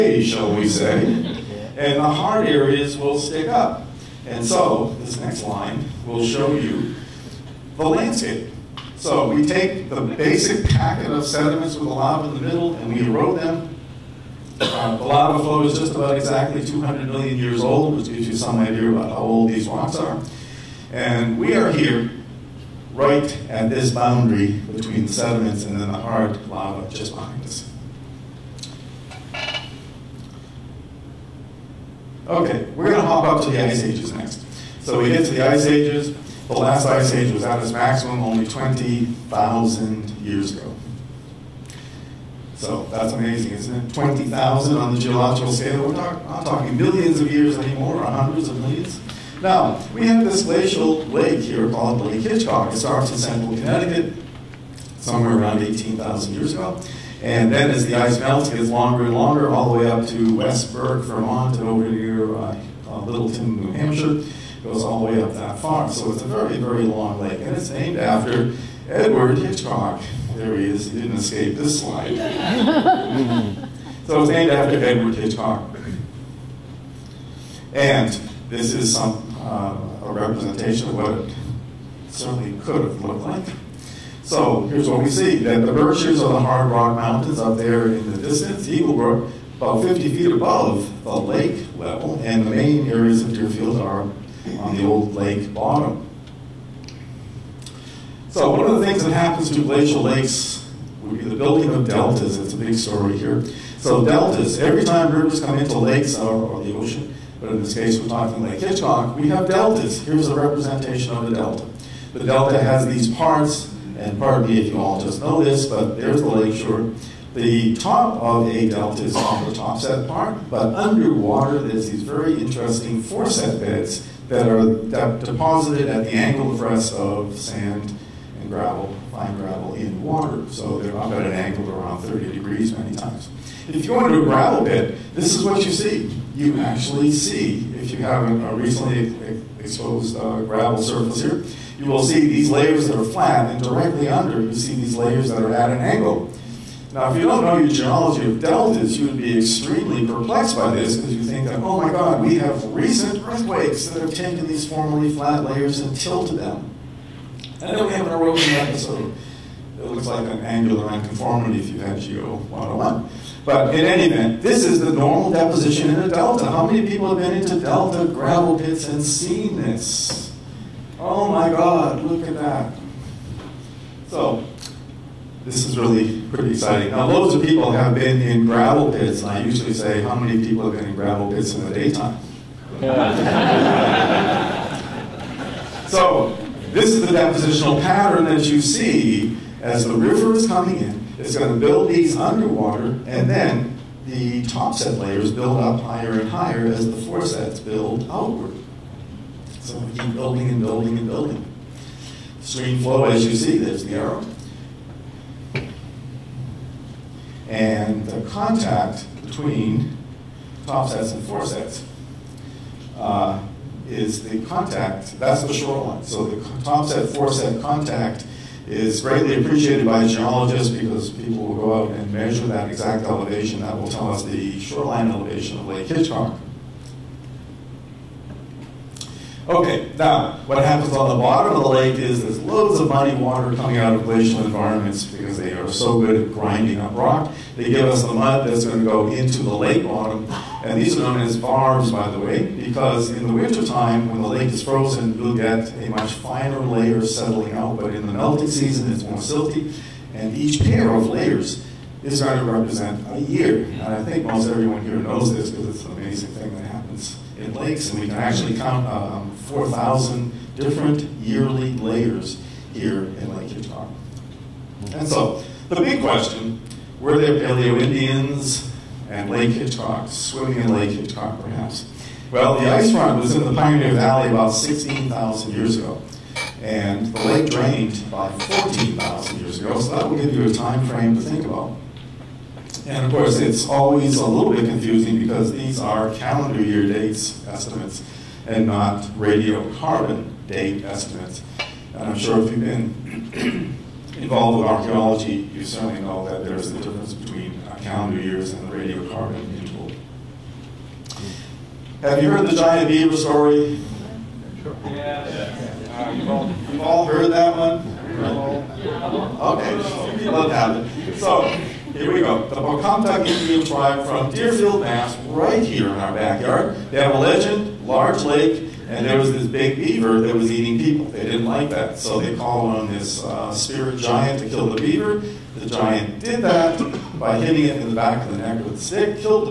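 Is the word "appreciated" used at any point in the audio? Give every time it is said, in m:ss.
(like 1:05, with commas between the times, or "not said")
3:39.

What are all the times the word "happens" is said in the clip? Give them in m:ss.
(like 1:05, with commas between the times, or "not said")
1:39, 3:50, 4:16.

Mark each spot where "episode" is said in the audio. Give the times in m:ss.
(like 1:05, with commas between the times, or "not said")
2:38.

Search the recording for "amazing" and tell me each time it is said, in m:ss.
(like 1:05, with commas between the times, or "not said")
0:43, 4:15.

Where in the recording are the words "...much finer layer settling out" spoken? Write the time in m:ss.
4:05.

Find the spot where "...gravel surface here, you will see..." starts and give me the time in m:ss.
2:20.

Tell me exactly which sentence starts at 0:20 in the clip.
And we are here, right at this boundary between the sediments and then the hard lava just behind us.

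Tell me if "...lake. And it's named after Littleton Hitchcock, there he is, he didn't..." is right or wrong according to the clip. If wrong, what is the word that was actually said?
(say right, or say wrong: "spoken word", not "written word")
wrong: "Edward", not "Littleton".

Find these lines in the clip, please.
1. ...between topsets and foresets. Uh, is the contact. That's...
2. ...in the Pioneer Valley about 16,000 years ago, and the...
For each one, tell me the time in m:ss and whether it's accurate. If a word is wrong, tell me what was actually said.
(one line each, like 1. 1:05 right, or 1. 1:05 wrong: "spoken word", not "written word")
1. 3:29 right
2. 4:33 right.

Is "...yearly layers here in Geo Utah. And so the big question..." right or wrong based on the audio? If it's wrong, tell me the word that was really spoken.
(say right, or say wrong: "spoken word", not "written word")
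wrong: "Lake", not "Geo".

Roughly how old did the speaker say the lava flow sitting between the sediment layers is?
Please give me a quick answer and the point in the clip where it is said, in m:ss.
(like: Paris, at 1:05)
200 million years, at 0:16.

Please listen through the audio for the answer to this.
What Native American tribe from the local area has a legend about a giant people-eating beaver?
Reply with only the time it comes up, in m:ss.
5:12.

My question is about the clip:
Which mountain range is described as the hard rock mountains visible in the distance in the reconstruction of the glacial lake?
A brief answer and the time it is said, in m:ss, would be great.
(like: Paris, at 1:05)
The Berkshires, at 1:25.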